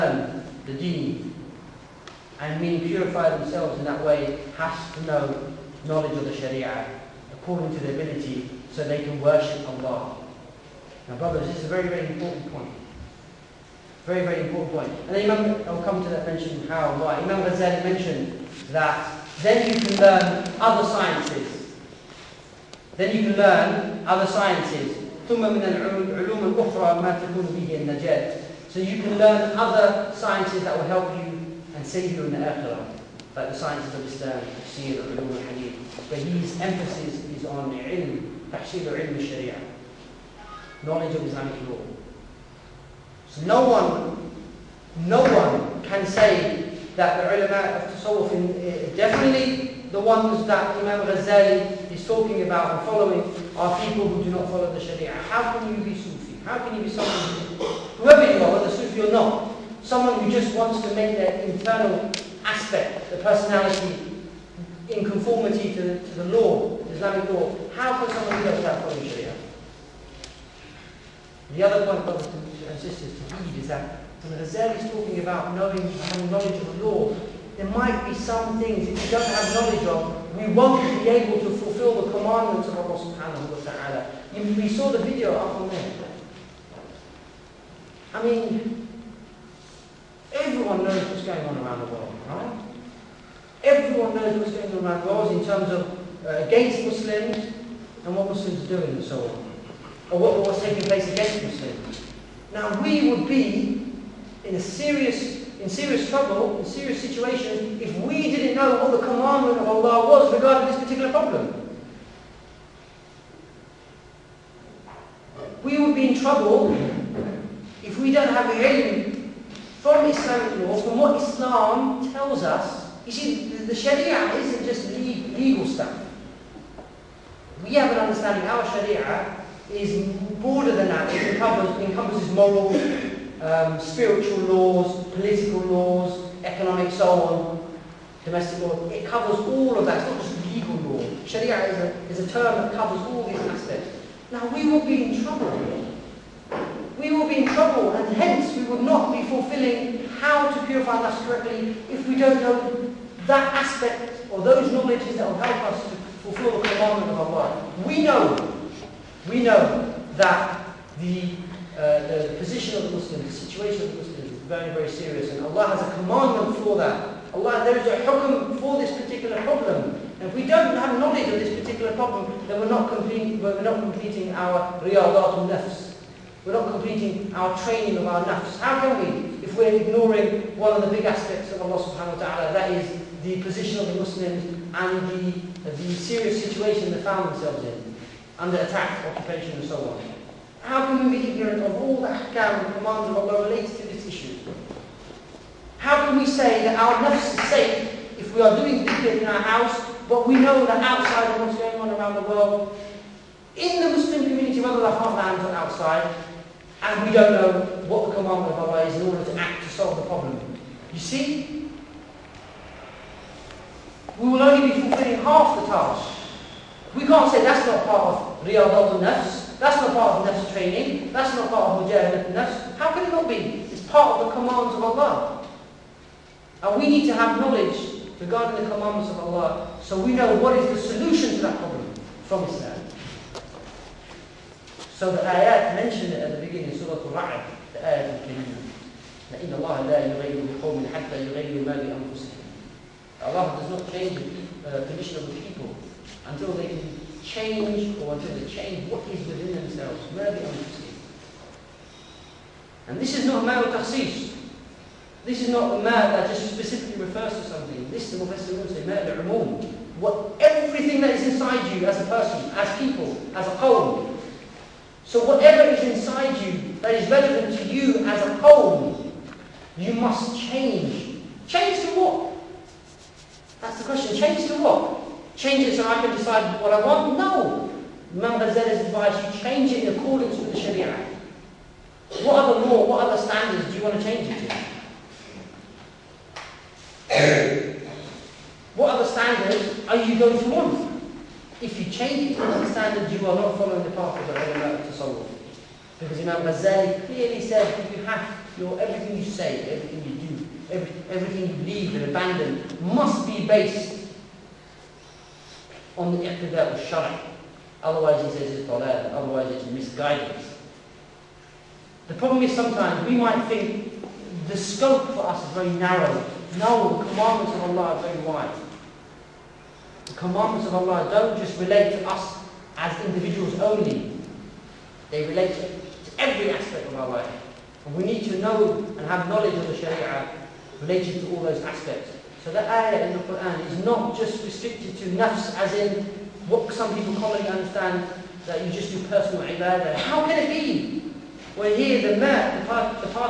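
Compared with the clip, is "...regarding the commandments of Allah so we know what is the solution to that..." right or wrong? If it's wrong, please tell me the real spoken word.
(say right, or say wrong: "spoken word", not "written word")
right.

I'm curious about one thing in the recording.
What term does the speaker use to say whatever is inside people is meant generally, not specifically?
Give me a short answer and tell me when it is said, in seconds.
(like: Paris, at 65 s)
mal umum, at 258 s.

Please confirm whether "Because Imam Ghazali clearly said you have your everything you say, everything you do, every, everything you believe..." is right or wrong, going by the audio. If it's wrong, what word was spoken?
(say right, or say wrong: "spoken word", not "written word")
right.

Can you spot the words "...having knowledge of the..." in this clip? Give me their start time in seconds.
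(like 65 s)
75 s.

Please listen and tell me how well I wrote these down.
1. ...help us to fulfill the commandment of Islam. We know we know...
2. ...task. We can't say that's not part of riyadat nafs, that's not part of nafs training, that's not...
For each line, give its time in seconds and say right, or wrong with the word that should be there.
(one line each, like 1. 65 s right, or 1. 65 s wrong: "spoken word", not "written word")
1. 155 s wrong: "Allah", not "Islam"
2. 215 s right.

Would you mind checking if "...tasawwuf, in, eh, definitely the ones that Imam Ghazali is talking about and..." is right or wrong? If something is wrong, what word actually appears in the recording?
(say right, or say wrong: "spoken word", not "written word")
right.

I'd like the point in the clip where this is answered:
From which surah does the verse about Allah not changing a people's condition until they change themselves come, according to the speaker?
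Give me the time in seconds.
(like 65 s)
236 s.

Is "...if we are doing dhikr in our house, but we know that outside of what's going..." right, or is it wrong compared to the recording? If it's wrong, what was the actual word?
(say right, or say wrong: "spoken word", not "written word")
right.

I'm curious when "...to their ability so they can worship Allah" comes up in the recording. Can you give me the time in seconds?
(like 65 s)
7 s.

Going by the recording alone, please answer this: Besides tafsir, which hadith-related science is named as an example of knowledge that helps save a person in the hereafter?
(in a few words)
ulum al-hadith.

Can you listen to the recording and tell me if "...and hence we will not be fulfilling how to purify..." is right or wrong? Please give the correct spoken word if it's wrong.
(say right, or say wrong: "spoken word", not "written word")
right.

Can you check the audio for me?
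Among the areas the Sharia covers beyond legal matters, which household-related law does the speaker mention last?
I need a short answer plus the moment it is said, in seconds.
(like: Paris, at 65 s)
domestic law, at 138 s.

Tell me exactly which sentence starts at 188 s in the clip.
under attack, occupation and so on.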